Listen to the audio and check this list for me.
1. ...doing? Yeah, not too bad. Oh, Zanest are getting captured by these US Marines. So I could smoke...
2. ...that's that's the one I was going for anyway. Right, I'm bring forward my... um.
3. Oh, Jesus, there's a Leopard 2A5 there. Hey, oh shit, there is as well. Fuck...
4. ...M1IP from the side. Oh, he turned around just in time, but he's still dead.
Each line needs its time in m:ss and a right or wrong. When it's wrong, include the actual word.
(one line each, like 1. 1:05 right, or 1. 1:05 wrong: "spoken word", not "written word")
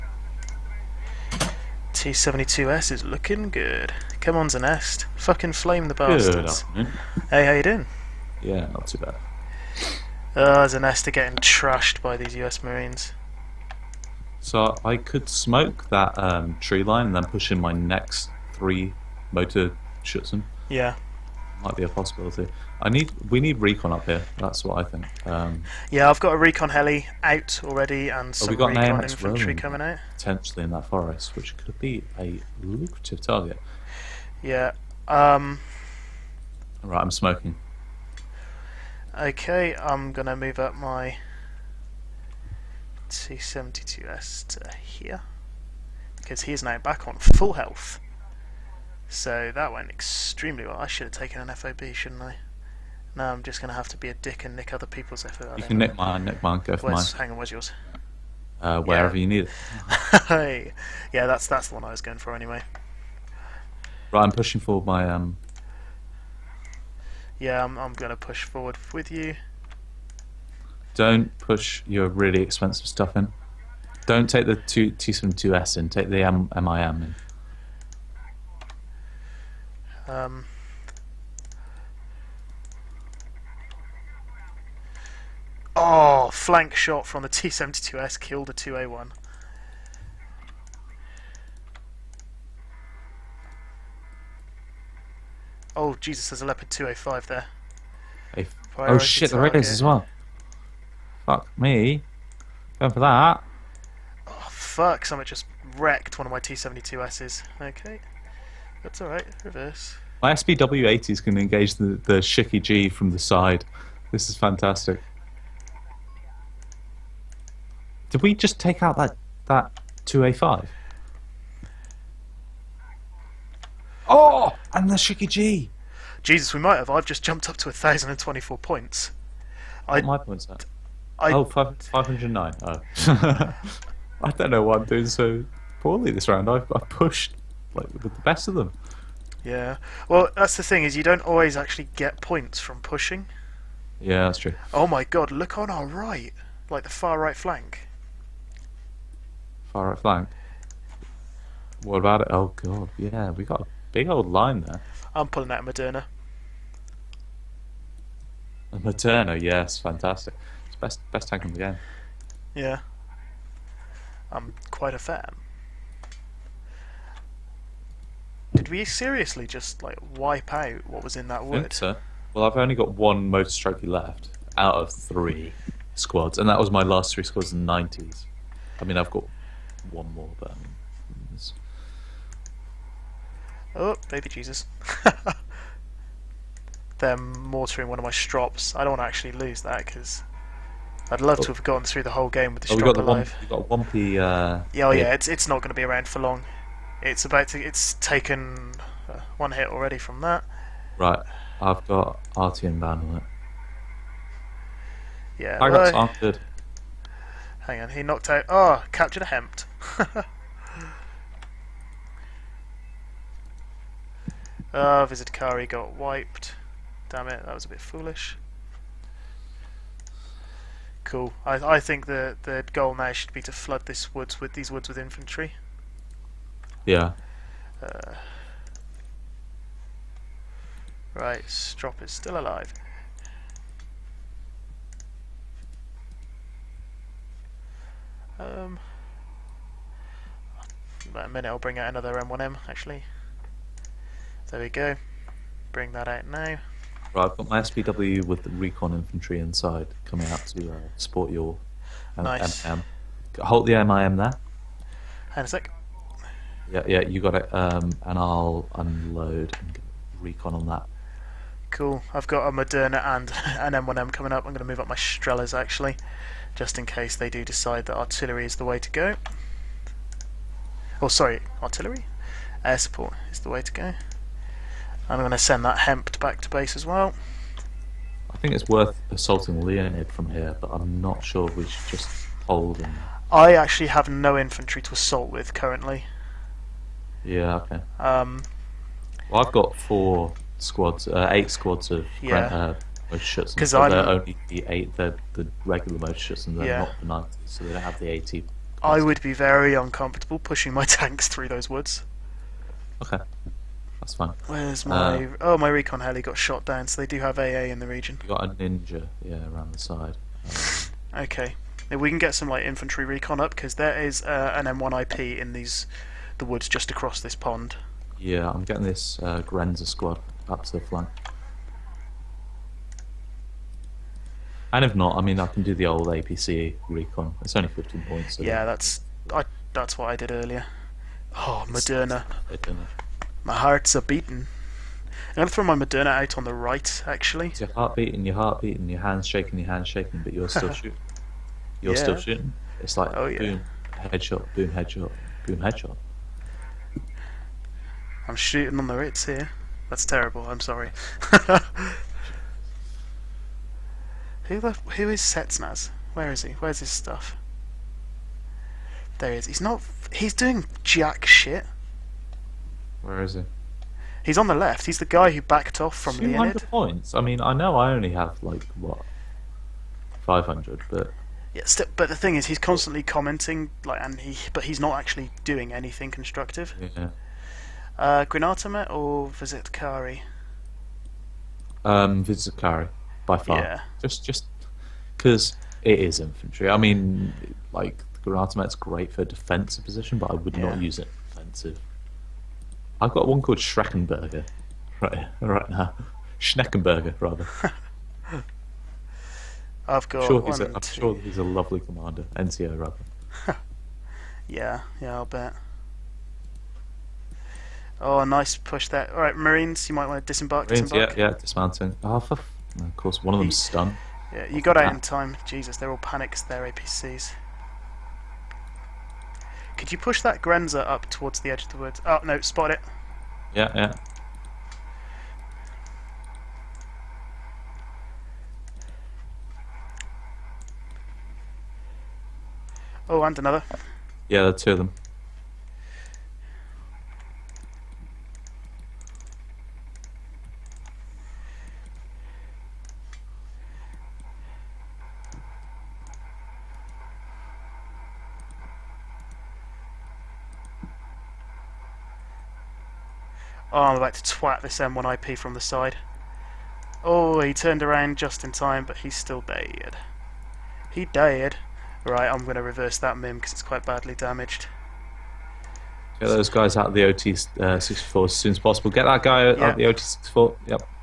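1. 0:07 wrong: "trashed", not "captured"
2. 1:01 wrong: "pushing", not "bring"
3. 1:35 right
4. 7:34 right.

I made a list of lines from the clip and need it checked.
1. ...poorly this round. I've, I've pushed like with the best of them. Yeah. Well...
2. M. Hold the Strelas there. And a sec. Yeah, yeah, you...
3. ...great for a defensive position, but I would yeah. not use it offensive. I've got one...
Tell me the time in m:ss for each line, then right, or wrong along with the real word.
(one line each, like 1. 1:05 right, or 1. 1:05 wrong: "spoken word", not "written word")
1. 2:15 right
2. 4:12 wrong: "MIM", not "Strelas"
3. 6:28 right.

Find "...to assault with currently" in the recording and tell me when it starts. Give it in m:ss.
4:44.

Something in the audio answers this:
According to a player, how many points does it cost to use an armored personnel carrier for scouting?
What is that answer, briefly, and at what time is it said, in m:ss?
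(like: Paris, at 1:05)
15, at 5:27.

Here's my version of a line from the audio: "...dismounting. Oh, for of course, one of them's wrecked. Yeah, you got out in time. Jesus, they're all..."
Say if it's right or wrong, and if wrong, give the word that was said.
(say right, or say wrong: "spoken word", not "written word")
wrong: "stunned", not "wrecked".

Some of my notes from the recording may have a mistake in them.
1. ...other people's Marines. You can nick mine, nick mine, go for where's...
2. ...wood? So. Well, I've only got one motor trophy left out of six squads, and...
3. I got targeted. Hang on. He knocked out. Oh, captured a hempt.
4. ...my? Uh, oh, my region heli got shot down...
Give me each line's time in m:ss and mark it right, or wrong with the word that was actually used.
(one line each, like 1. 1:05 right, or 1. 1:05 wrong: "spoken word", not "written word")
1. 0:54 wrong: "FOB", not "Marines"
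2. 2:51 wrong: "three", not "six"
3. 3:25 right
4. 5:04 wrong: "recon", not "region".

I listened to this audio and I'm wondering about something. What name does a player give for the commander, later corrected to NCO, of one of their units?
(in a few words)
Schneckenberger.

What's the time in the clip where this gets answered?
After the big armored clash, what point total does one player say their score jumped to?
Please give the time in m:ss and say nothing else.
2:07.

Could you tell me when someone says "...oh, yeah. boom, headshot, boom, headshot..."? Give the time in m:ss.
5:43.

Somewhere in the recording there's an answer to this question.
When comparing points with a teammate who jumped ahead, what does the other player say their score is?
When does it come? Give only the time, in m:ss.
2:11.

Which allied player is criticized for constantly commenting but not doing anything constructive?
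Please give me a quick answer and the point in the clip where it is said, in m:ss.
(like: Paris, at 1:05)
Spetsnaz, at 5:55.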